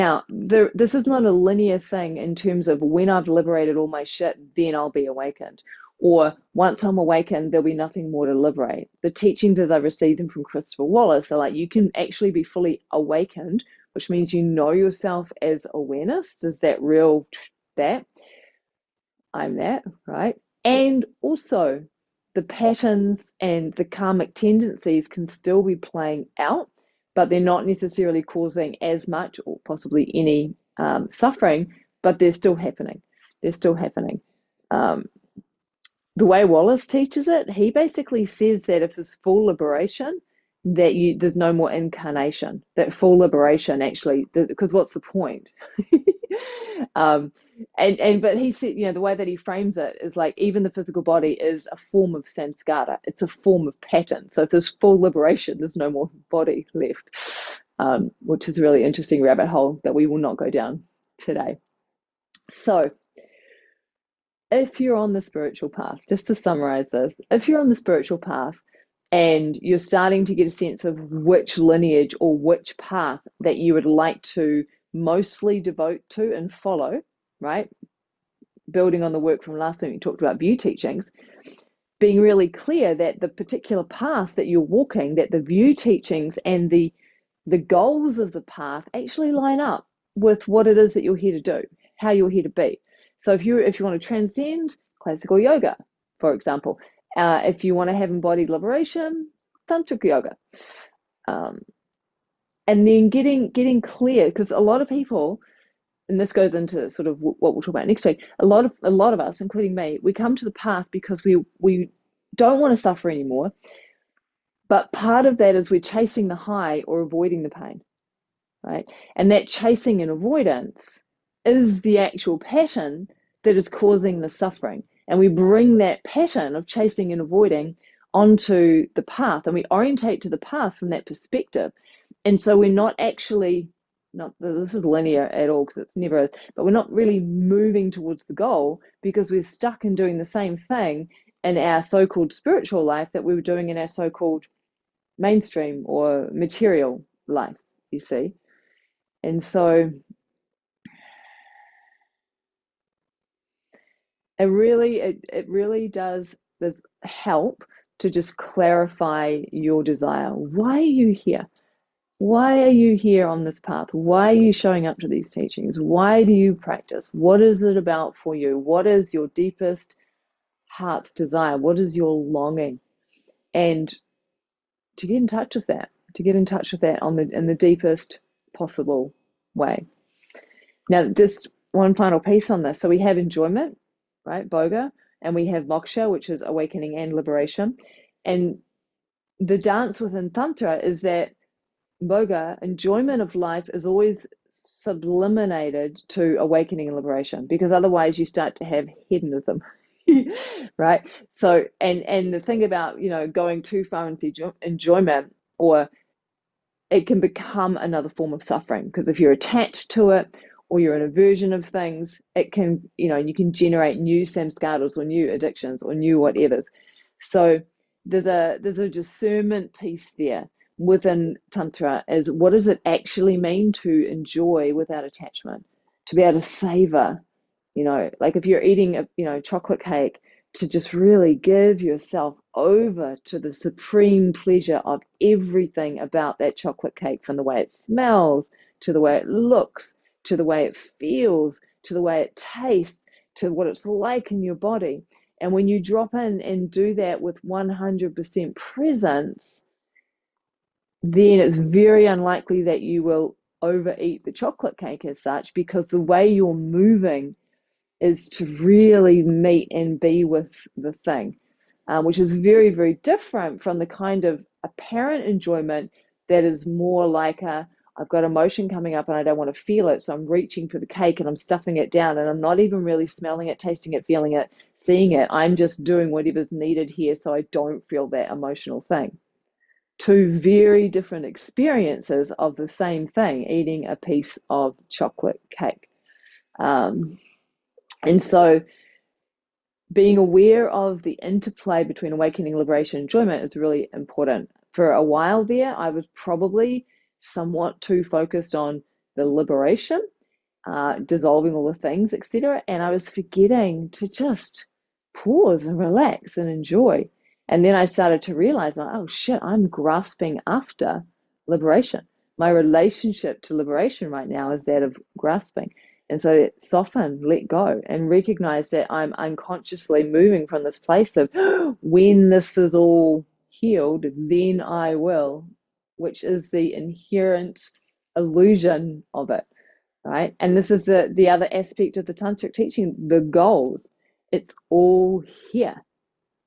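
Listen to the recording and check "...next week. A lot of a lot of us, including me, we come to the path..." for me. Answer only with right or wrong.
right.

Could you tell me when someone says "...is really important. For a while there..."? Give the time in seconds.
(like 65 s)
293 s.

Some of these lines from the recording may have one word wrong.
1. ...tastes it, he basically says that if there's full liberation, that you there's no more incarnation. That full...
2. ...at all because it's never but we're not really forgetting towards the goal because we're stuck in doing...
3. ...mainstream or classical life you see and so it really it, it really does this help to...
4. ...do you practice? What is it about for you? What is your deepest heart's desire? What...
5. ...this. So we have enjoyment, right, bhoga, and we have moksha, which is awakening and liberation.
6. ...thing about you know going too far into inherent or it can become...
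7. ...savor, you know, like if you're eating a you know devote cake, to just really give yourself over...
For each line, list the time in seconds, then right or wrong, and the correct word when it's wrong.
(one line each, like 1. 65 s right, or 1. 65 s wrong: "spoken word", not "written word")
1. 36 s wrong: "teaches", not "tastes"
2. 135 s wrong: "moving", not "forgetting"
3. 145 s wrong: "material", not "classical"
4. 166 s right
5. 182 s right
6. 202 s wrong: "enjoyment", not "inherent"
7. 226 s wrong: "chocolate", not "devote".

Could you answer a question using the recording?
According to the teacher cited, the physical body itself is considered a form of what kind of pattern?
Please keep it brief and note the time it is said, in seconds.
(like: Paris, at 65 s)
samskara, at 52 s.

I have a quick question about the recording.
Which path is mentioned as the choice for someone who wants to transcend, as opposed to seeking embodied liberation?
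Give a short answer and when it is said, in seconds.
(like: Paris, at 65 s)
classical yoga, at 95 s.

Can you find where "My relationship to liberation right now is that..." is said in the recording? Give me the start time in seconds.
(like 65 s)
312 s.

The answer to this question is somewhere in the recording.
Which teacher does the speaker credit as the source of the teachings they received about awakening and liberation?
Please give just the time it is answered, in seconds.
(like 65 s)
10 s.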